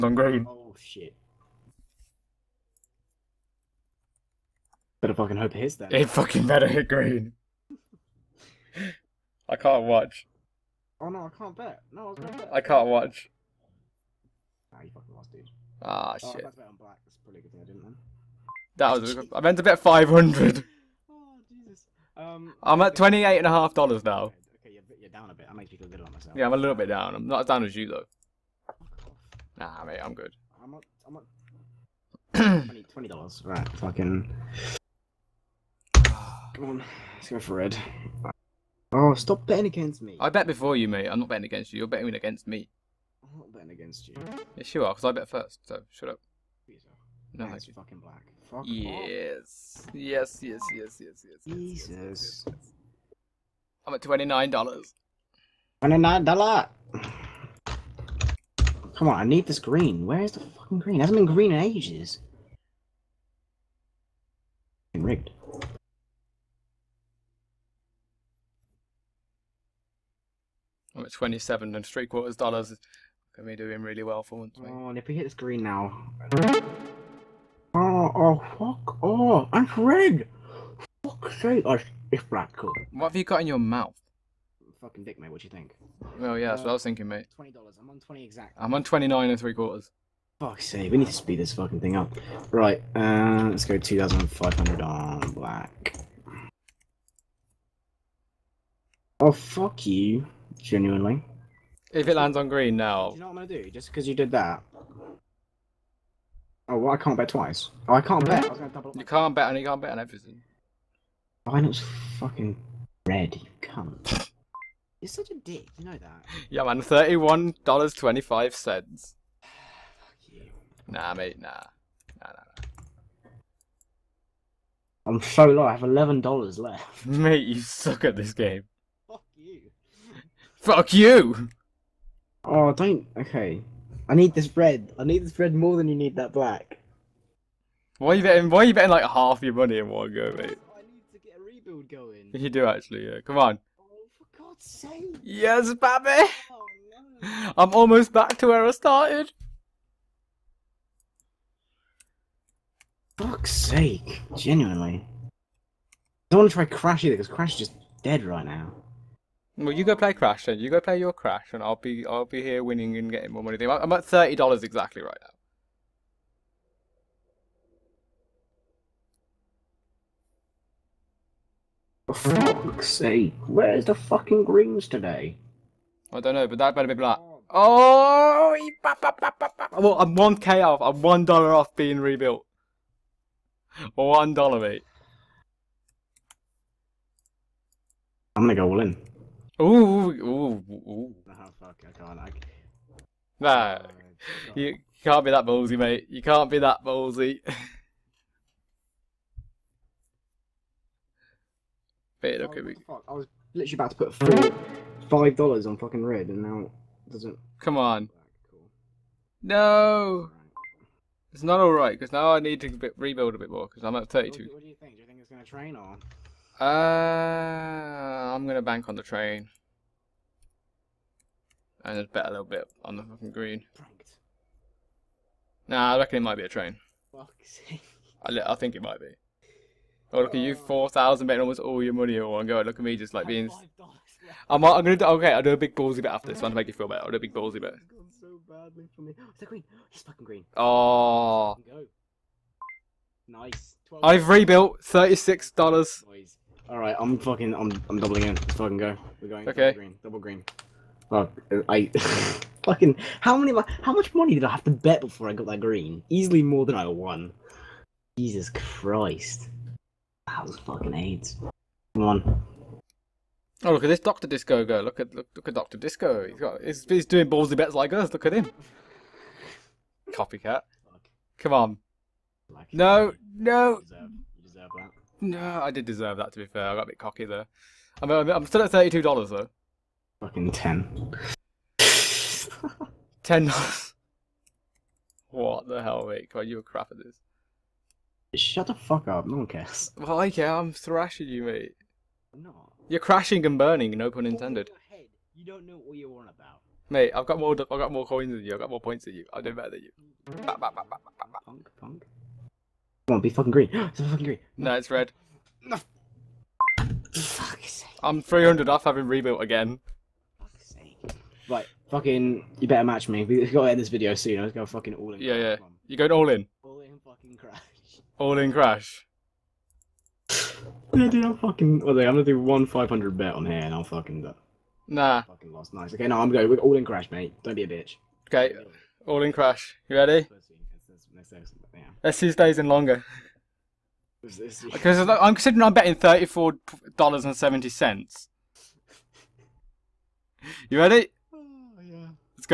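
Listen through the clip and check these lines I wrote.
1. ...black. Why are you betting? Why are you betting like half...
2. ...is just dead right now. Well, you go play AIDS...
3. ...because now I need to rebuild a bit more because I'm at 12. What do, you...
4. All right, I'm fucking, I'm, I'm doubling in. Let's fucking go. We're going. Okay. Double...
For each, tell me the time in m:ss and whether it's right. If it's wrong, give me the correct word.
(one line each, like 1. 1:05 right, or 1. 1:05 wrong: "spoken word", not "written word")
1. 2:16 right
2. 2:37 wrong: "Crash", not "AIDS"
3. 3:31 wrong: "32", not "12"
4. 4:06 right.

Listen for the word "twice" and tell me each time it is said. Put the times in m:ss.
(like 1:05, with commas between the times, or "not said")
1:47.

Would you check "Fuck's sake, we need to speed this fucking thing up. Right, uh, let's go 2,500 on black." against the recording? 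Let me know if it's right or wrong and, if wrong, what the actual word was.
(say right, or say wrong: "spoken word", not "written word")
right.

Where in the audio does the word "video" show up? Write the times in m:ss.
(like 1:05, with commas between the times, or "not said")
5:13.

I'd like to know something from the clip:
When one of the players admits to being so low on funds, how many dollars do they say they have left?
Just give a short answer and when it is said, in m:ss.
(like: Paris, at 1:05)
$11, at 2:05.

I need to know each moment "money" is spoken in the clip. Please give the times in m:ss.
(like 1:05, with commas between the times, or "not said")
2:19, 2:43, 3:51, 4:14.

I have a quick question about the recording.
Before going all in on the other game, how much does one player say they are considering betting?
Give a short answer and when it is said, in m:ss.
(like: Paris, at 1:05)
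$34.70, at 5:35.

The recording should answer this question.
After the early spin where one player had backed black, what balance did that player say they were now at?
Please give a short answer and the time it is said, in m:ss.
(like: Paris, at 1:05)
$28.50, at 0:22.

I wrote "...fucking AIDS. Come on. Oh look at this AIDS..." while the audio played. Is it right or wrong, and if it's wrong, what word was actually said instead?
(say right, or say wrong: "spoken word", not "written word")
wrong: "Doctor", not "AIDS".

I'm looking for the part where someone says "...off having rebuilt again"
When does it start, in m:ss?
5:08.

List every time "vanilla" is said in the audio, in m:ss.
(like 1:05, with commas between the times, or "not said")
not said.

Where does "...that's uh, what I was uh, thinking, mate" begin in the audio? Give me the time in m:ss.
1:26.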